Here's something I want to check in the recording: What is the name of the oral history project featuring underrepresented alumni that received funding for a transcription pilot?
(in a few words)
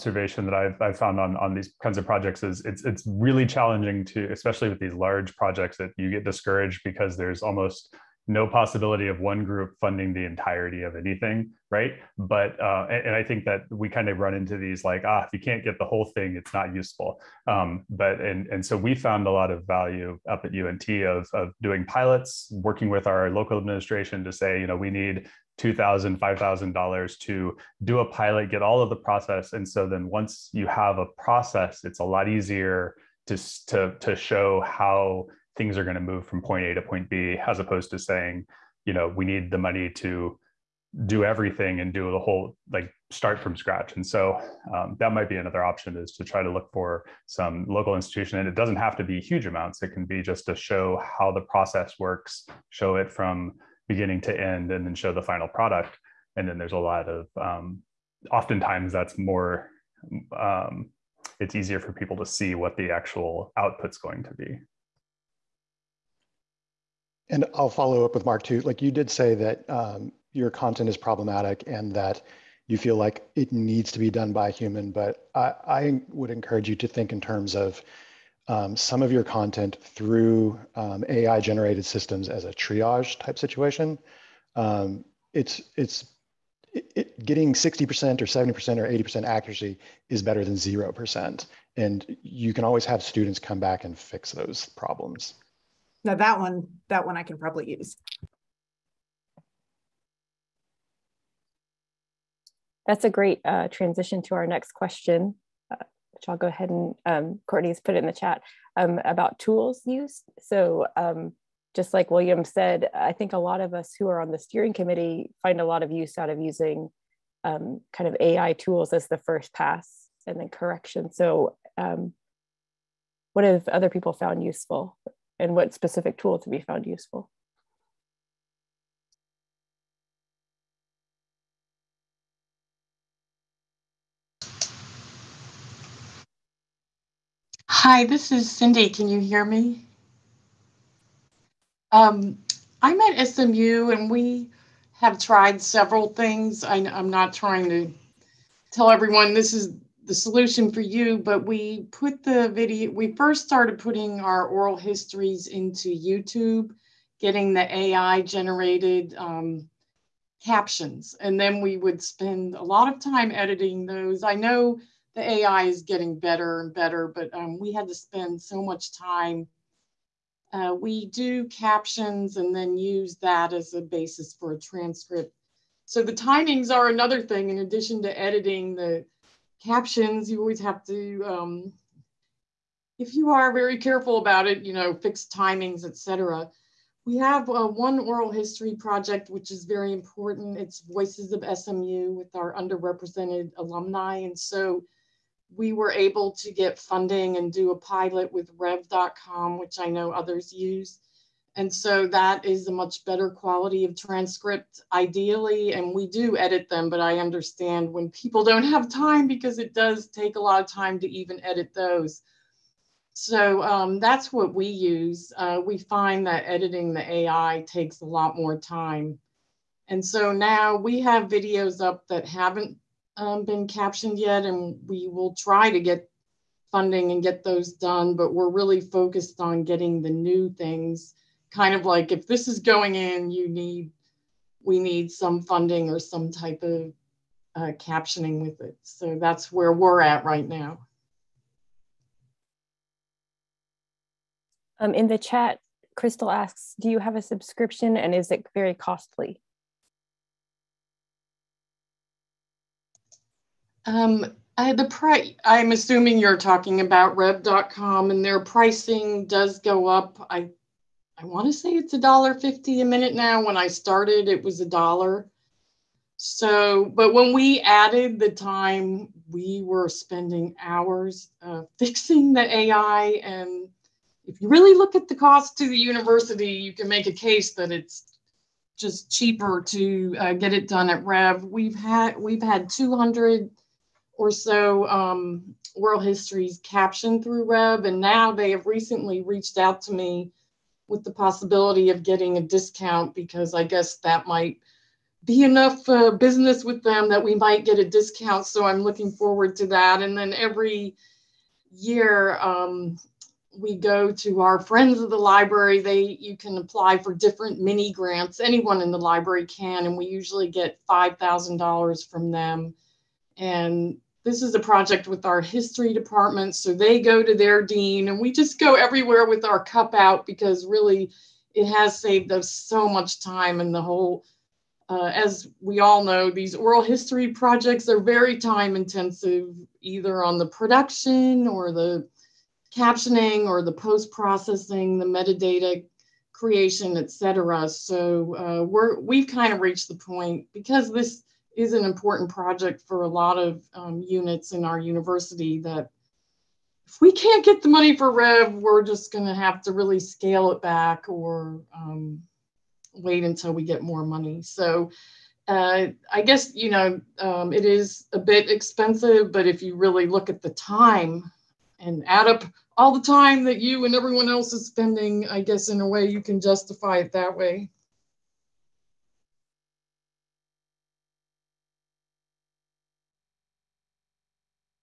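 Voices of SMU.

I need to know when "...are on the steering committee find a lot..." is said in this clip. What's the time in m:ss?
1:54.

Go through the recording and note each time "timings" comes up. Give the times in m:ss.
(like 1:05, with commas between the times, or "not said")
2:56, 3:05.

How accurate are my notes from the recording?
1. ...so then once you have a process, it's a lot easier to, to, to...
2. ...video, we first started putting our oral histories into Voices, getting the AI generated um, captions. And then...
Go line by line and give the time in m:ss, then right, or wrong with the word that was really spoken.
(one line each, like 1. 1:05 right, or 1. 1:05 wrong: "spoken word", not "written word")
1. 0:29 right
2. 2:32 wrong: "YouTube", not "Voices".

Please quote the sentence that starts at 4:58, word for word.
So I'm looking forward to that.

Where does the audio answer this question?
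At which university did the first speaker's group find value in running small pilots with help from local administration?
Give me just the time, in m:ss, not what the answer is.
0:20.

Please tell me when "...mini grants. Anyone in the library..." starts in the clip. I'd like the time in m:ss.
5:07.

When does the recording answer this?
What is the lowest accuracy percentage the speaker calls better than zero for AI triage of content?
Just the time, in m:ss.
1:27.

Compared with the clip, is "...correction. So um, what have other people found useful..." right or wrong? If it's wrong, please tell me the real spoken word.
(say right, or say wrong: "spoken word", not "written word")
right.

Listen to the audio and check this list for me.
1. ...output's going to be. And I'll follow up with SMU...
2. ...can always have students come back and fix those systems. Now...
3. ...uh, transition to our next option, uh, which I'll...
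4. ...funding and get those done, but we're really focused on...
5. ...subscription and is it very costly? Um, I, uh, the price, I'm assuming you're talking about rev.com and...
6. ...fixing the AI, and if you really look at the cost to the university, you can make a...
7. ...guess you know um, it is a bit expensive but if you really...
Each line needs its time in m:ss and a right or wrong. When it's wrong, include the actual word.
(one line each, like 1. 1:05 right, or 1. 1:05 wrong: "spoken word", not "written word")
1. 1:03 wrong: "Mark", not "SMU"
2. 1:32 wrong: "problems", not "systems"
3. 1:43 wrong: "question", not "option"
4. 3:46 right
5. 4:07 right
6. 4:31 right
7. 5:56 right.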